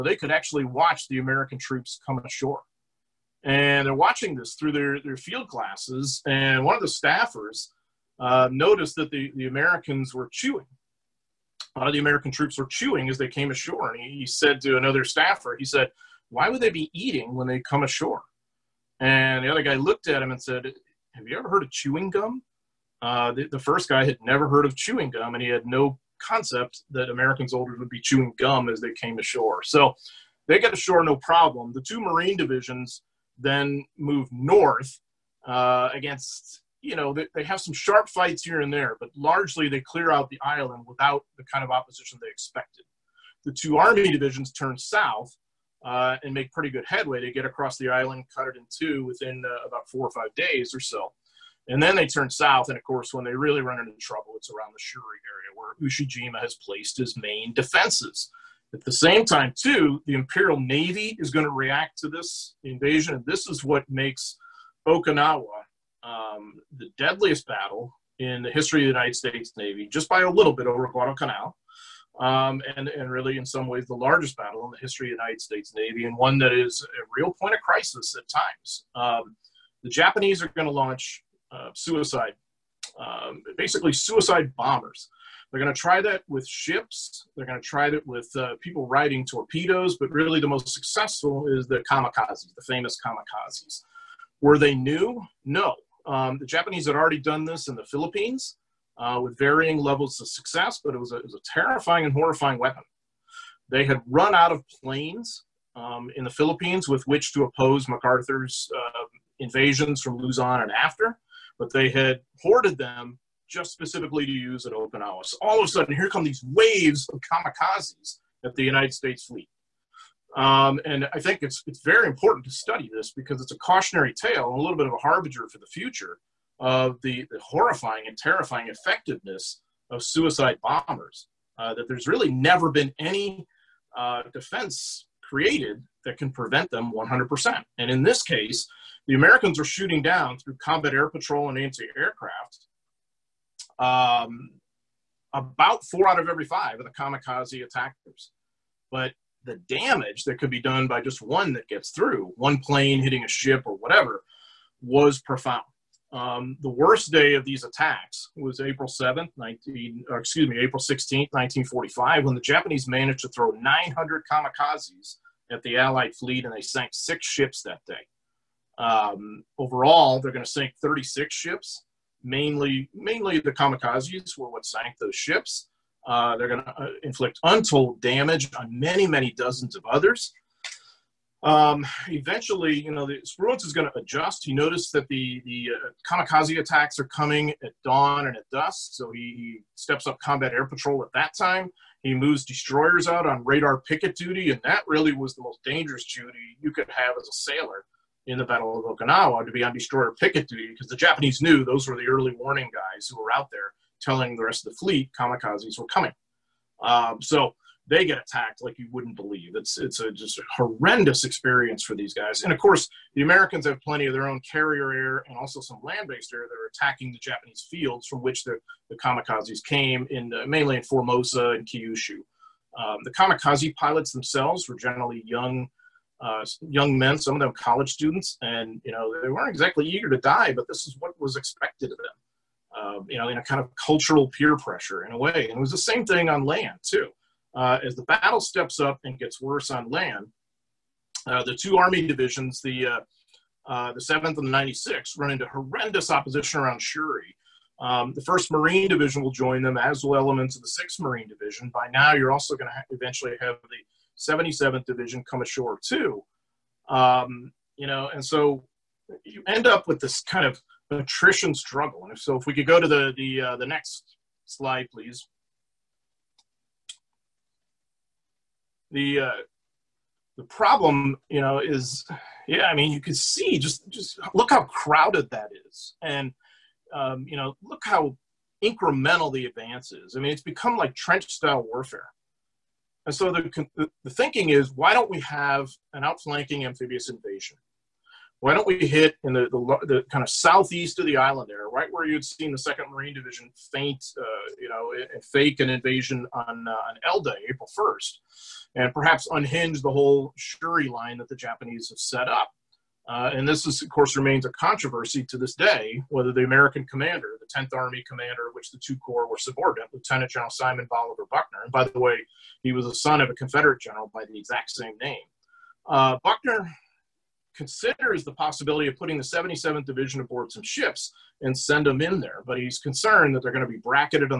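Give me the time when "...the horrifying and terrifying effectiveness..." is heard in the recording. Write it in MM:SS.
02:07.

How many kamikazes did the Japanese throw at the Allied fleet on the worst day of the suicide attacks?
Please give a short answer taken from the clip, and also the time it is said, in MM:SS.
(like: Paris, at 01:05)
900, at 02:43.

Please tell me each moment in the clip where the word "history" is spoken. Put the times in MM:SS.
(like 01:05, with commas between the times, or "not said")
01:08, 01:14.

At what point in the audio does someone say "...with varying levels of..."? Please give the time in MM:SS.
01:39.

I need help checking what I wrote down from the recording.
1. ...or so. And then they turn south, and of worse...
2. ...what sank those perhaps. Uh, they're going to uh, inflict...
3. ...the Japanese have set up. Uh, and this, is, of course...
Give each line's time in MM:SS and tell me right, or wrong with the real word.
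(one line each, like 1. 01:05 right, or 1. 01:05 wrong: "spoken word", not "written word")
1. 00:50 wrong: "course", not "worse"
2. 02:54 wrong: "ships", not "perhaps"
3. 05:01 right.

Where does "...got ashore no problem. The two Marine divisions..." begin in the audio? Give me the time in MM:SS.
00:30.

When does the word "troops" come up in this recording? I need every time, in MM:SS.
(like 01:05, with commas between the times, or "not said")
00:01, 00:12.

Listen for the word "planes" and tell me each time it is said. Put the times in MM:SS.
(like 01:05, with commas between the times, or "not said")
01:44, 02:32.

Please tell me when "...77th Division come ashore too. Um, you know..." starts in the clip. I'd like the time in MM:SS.
04:14.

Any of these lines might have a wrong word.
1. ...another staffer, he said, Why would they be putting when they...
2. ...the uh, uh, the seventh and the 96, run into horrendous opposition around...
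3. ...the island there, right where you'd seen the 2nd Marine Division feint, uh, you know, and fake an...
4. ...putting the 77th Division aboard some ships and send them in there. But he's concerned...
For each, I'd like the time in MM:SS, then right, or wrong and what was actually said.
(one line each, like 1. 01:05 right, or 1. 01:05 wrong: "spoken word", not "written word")
1. 00:14 wrong: "eating", not "putting"
2. 04:02 right
3. 04:51 right
4. 05:18 right.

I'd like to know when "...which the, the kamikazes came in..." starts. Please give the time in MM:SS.
03:38.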